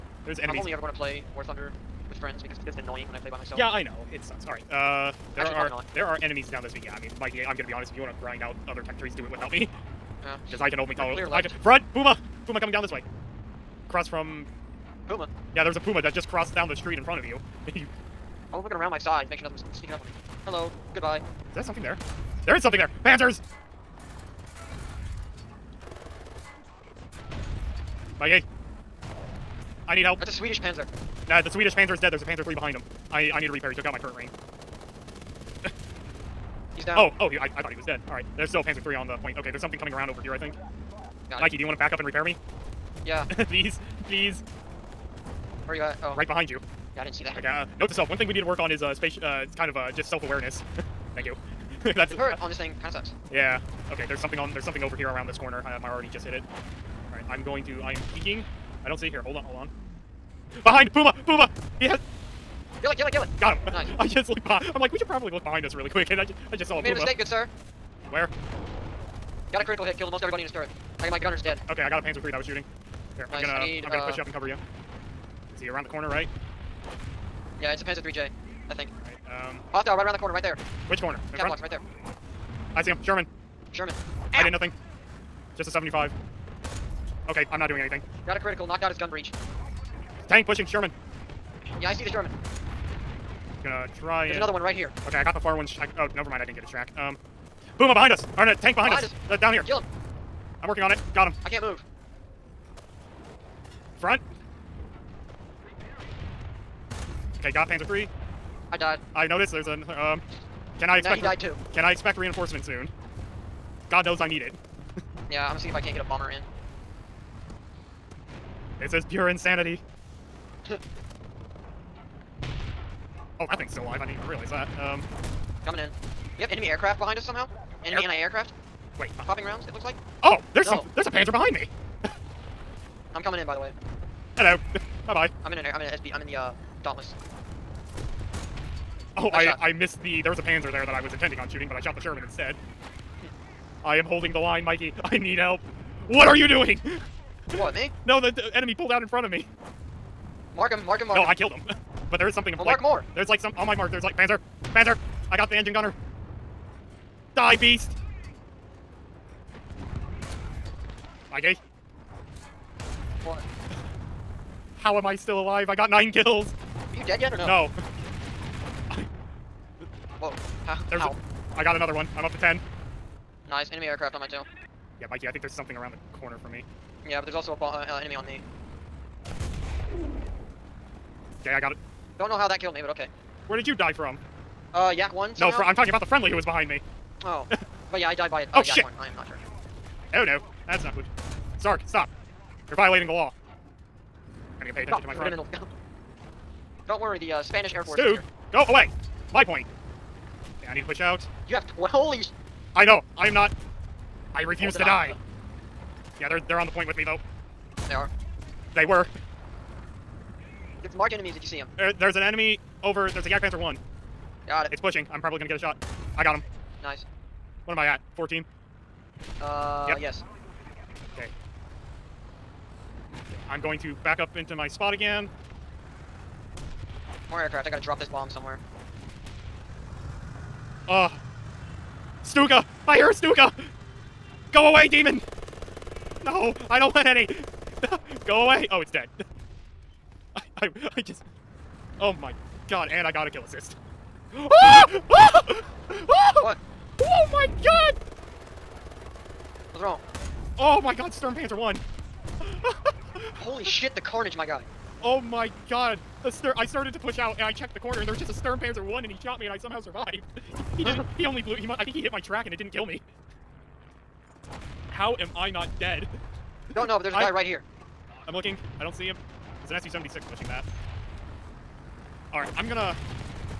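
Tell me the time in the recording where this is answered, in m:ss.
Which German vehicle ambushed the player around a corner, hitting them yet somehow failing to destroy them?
4:18.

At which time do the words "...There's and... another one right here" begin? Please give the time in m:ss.
1:34.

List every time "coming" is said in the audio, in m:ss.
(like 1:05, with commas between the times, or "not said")
0:12, 0:39, 2:05, 2:13.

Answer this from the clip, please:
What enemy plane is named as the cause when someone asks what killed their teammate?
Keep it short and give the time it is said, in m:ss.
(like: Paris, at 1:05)
Yak 1, at 3:04.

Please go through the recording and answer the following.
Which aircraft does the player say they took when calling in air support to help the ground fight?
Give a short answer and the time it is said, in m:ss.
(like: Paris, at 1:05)
Dauntless, at 2:16.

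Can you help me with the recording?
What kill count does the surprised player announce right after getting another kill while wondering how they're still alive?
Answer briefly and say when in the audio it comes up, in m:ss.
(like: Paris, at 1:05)
10, at 2:52.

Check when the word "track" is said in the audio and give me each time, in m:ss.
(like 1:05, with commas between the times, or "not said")
1:36, 4:22.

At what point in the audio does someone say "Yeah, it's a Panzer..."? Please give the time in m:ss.
1:17.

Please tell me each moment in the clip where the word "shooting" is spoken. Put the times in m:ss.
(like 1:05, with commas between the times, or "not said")
1:12, 2:21.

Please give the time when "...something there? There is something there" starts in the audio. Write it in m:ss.
0:21.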